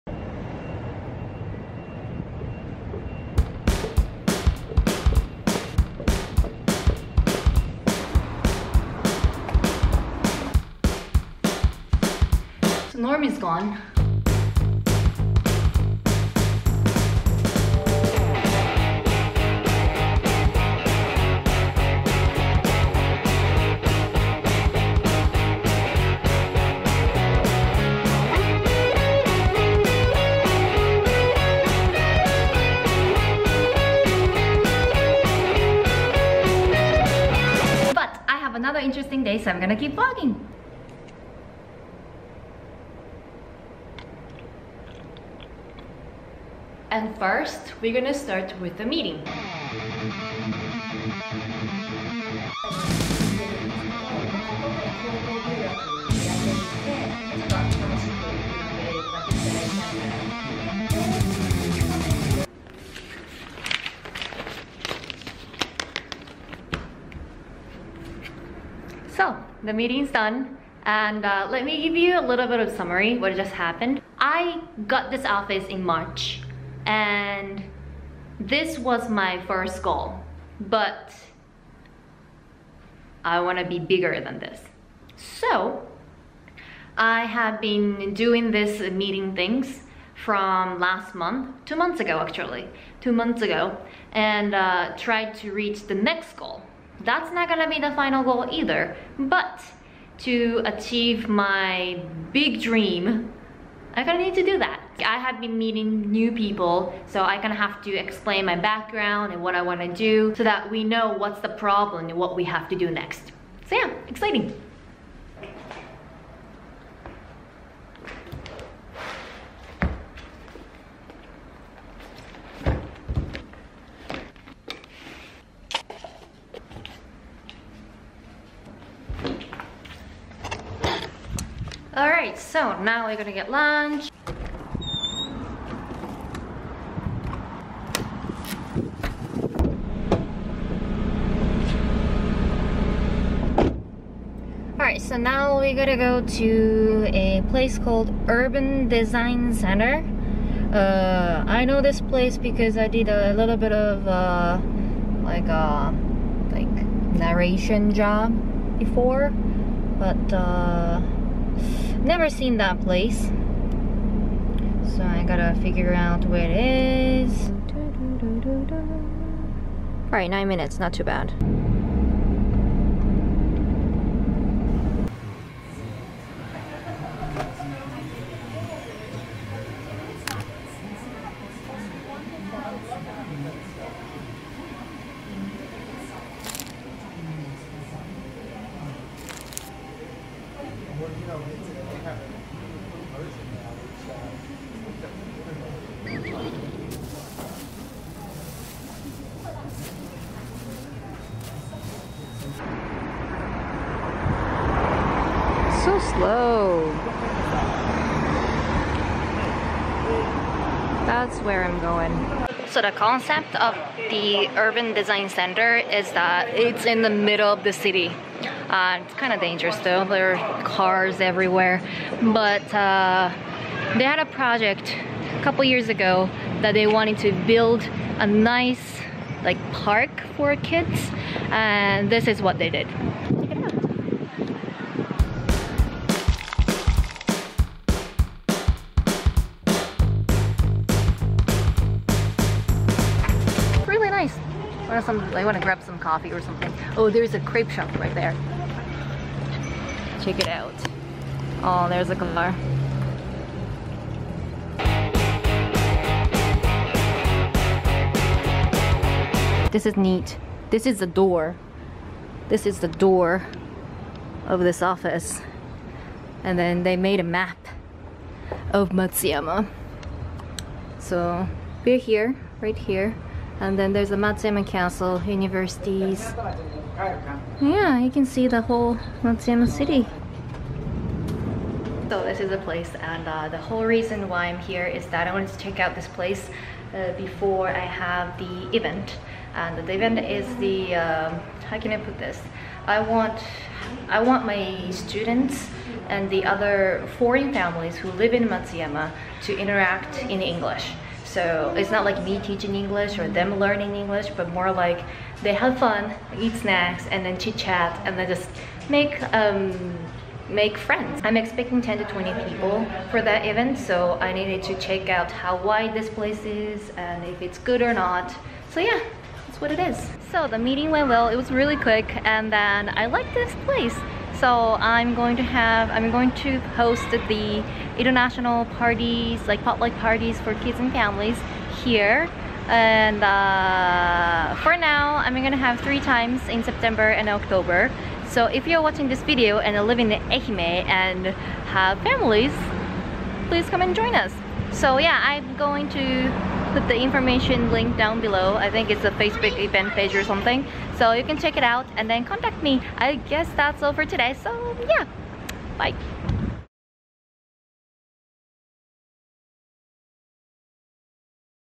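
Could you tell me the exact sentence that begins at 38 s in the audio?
another interesting day, so I'm gonna keep vlogging.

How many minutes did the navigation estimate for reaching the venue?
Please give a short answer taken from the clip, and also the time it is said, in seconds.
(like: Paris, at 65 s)
9, at 170 s.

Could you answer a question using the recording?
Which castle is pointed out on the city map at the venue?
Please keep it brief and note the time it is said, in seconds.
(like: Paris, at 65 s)
Matsuyama Castle, at 274 s.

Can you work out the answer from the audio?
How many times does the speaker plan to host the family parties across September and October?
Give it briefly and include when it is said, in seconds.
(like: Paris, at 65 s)
3, at 335 s.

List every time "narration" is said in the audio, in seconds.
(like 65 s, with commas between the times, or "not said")
157 s.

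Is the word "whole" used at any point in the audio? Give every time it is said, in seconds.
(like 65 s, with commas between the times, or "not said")
278 s, 283 s.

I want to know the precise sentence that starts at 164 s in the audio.
So I gotta figure out where it is.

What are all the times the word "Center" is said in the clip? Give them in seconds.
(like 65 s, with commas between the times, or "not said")
149 s, 215 s.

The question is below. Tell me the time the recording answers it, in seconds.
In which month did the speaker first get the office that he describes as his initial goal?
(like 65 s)
75 s.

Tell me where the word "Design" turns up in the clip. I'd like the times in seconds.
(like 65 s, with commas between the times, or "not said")
148 s, 214 s.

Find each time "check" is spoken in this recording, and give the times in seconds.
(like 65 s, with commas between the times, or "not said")
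250 s, 285 s, 314 s, 351 s.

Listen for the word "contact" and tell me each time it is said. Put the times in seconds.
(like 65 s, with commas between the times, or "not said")
352 s.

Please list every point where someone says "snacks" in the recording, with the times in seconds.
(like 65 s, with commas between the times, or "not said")
306 s.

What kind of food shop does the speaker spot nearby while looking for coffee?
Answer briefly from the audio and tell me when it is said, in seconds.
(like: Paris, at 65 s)
Crepe shop, at 247 s.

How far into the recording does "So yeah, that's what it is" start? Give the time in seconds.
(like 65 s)
318 s.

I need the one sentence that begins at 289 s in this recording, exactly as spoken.
And the event is the, um, how can I put this?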